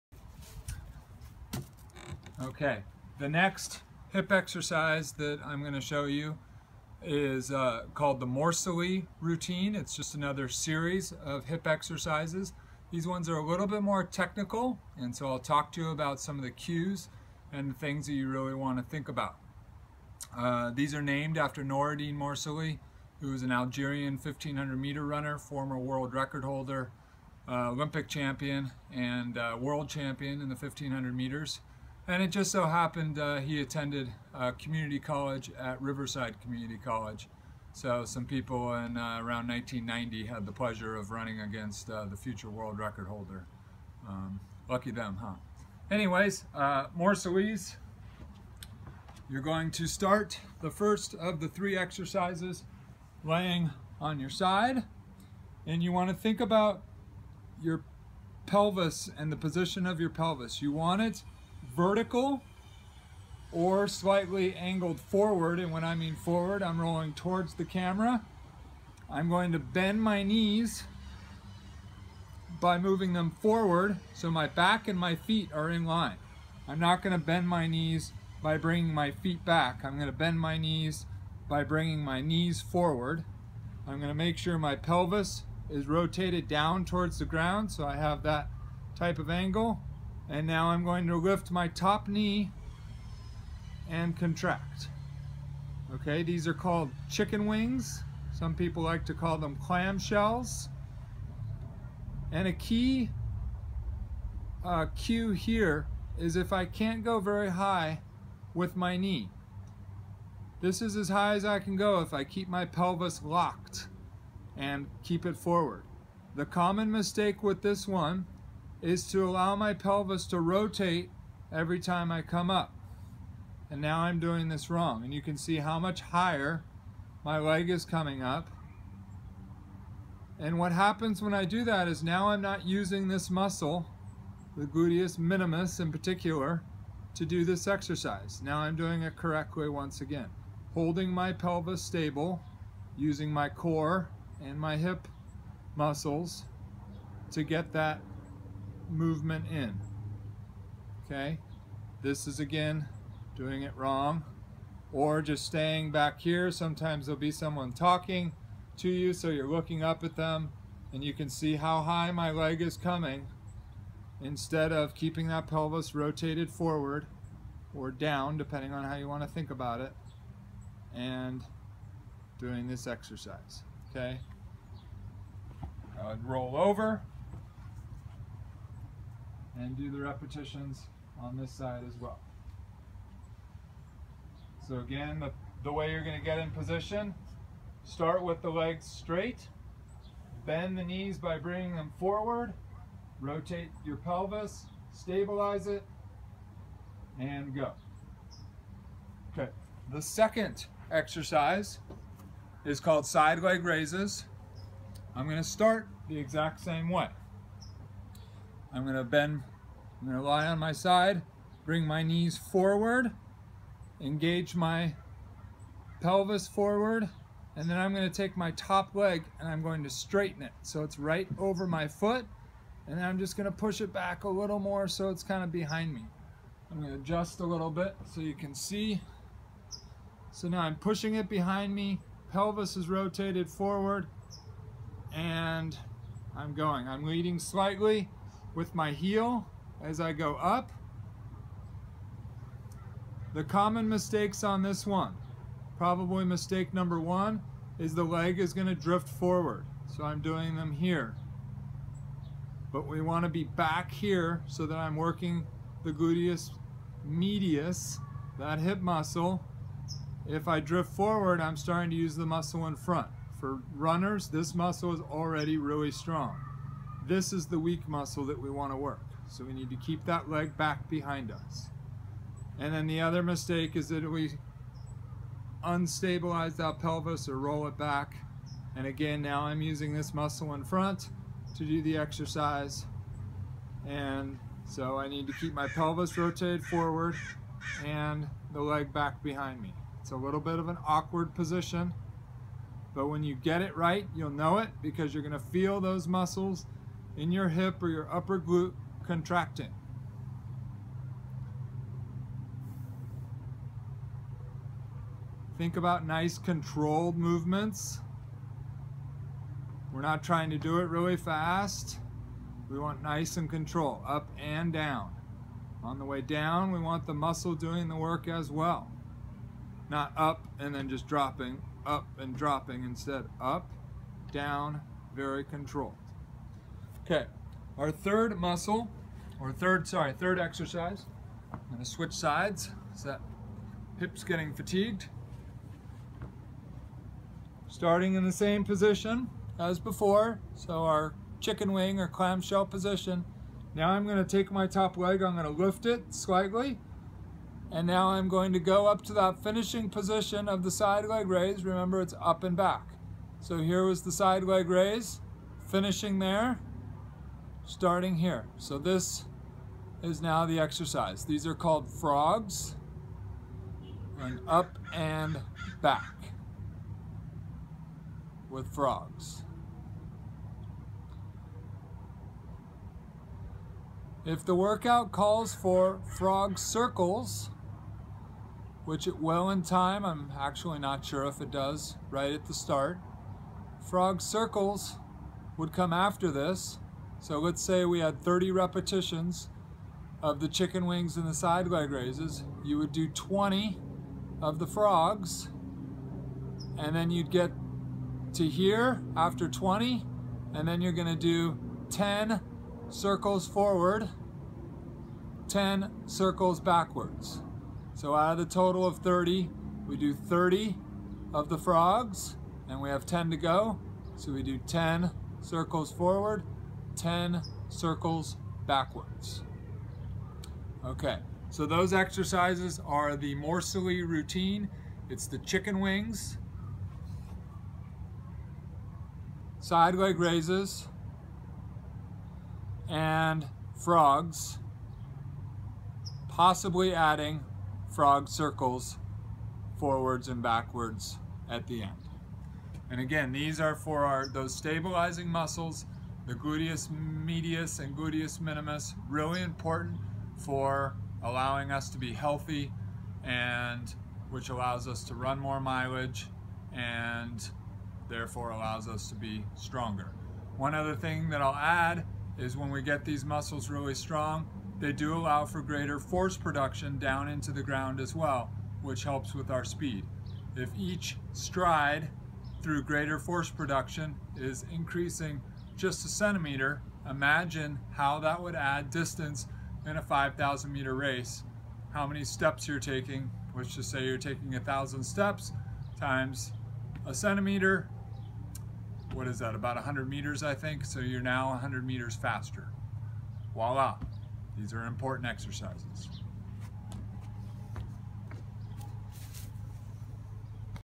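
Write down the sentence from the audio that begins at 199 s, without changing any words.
Okay, the second exercise is called side leg raises.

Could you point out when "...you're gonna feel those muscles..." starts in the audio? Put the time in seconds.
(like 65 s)
295 s.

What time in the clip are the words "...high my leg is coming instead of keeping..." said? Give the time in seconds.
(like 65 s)
161 s.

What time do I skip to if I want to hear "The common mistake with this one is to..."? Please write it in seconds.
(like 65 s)
116 s.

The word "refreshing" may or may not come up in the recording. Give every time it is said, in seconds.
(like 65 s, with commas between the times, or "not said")
not said.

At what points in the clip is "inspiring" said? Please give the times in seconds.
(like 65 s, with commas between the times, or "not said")
not said.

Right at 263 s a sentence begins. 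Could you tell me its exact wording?
For runners, this muscle is already really strong.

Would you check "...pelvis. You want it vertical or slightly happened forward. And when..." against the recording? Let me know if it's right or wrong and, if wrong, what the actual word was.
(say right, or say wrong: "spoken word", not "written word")
wrong: "angled", not "happened".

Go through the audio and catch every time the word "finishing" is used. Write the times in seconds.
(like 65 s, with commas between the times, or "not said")
349 s, 355 s.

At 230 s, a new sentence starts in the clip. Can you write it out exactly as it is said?
So now I'm pushing it behind me, pelvis is rotated forward, and I'm going.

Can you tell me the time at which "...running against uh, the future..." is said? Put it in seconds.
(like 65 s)
41 s.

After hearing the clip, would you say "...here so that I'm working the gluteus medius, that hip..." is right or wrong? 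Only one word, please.
right.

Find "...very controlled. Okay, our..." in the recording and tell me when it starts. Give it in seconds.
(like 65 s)
325 s.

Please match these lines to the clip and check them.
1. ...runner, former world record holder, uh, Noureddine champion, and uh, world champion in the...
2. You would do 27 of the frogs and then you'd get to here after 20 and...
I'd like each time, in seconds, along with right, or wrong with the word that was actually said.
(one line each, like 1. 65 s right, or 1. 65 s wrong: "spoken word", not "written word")
1. 25 s wrong: "Olympic", not "Noureddine"
2. 392 s wrong: "20", not "27".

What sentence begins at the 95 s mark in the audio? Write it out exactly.
Okay, these are called chicken wings.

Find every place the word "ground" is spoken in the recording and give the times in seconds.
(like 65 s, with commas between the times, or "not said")
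87 s, 467 s.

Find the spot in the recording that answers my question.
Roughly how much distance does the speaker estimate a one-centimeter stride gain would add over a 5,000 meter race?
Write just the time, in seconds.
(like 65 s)
489 s.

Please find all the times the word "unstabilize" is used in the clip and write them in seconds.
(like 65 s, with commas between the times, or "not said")
275 s.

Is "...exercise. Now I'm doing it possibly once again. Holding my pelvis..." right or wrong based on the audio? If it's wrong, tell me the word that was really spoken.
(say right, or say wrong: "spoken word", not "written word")
wrong: "correctly", not "possibly".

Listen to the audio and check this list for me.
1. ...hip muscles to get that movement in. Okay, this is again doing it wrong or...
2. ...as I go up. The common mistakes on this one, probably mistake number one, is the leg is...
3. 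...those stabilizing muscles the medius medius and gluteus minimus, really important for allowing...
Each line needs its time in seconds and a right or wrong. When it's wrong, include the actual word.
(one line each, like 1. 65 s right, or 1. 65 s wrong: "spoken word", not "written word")
1. 144 s right
2. 239 s right
3. 444 s wrong: "gluteus", not "medius".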